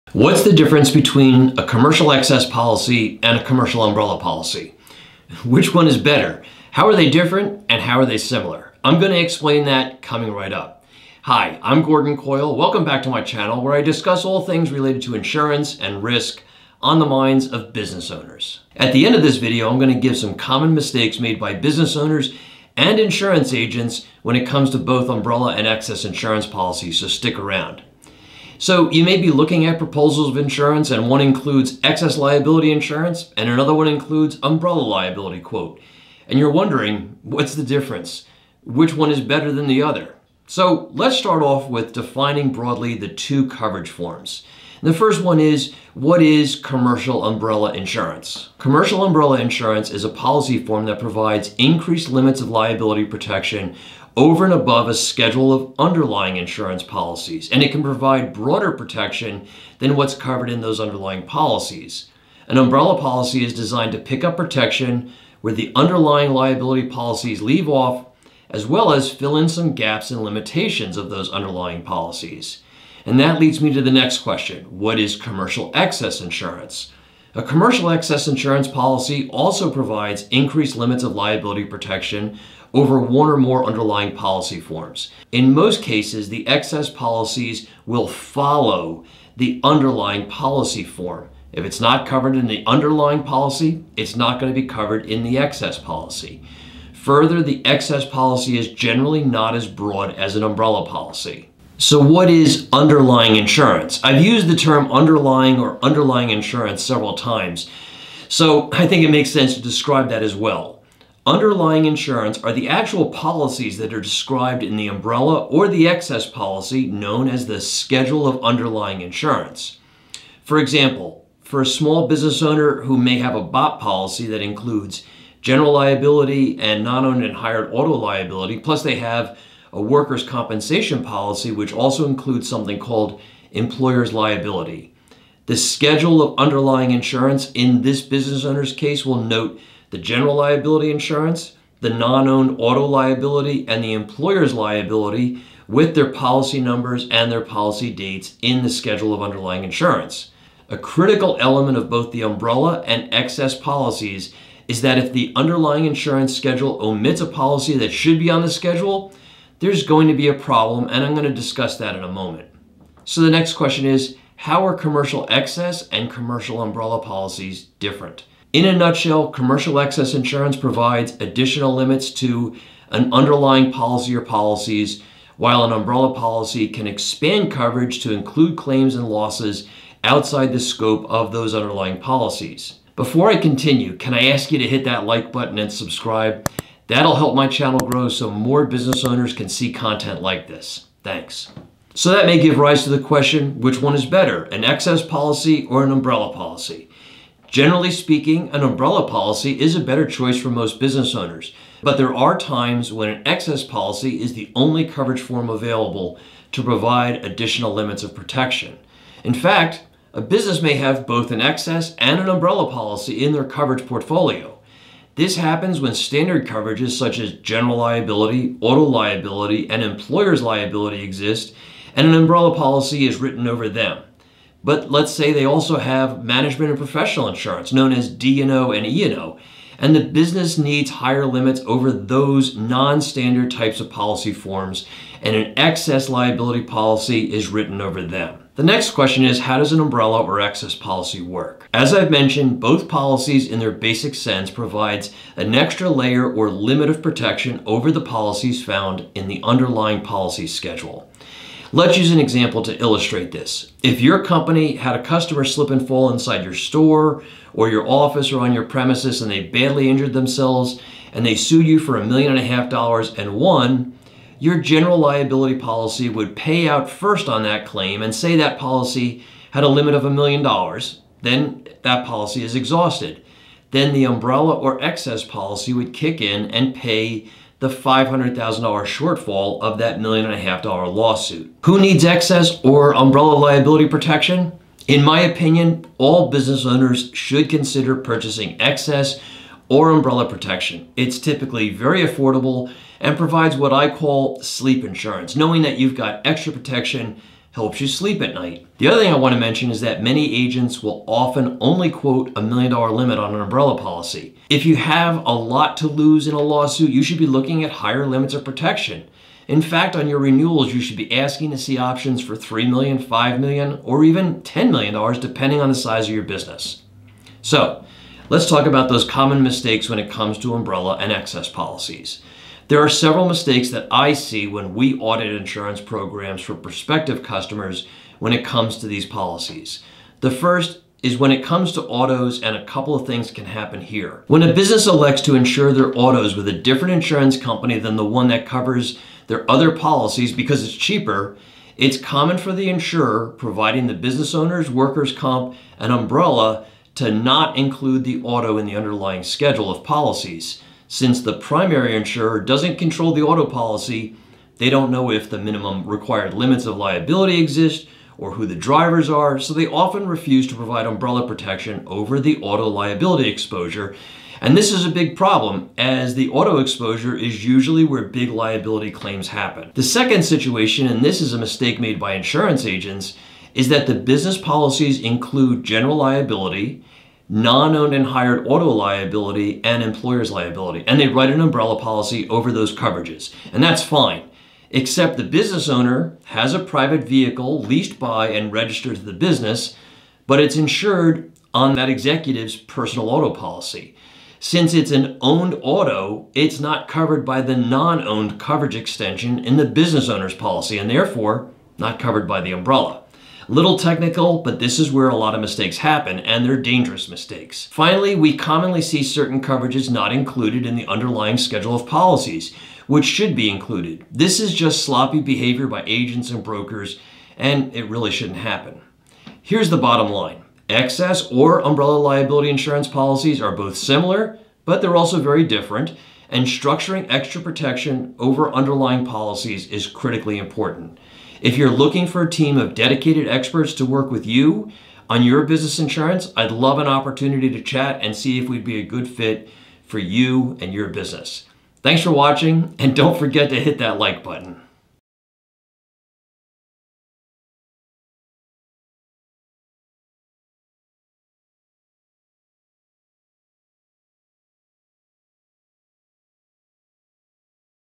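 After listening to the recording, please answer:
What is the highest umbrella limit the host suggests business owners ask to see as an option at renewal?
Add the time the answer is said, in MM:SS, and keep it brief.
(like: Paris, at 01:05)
$10 million, at 05:14.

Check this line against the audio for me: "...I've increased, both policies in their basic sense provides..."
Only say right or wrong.
wrong.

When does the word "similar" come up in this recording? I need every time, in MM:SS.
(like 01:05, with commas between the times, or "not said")
00:08, 07:03.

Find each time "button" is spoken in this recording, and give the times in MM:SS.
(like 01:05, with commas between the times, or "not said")
03:05, 07:24.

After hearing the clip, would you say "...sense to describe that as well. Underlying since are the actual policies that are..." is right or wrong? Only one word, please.
wrong.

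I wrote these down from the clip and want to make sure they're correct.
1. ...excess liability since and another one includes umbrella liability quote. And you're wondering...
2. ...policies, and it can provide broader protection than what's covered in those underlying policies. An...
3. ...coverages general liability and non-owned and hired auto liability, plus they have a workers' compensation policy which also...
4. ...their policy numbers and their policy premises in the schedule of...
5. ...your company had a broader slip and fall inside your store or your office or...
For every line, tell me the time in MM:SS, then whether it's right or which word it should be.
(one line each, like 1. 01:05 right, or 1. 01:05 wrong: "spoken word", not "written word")
1. 00:31 wrong: "insurance", not "since"
2. 00:56 right
3. 02:04 wrong: "includes", not "coverages"
4. 02:25 wrong: "dates", not "premises"
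5. 04:14 wrong: "customer", not "broader".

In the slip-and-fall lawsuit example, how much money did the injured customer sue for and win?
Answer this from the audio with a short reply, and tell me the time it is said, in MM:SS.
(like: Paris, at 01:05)
$1.5 million, at 04:21.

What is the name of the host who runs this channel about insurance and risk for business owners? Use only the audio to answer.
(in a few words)
Gordon Coyle.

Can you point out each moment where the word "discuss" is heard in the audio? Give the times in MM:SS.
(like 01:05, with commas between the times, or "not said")
00:13, 02:41.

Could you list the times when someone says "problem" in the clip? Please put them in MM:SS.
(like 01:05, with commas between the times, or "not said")
02:40, 06:05.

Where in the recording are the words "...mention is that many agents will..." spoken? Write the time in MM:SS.
04:59.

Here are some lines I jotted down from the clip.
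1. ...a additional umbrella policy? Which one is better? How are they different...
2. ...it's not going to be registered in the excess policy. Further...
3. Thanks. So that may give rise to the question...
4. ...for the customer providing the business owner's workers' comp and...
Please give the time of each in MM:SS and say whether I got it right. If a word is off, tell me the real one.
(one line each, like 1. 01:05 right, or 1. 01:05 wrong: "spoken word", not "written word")
1. 00:03 wrong: "commercial", not "additional"
2. 01:33 wrong: "covered", not "registered"
3. 03:11 right
4. 05:42 wrong: "insurer", not "customer".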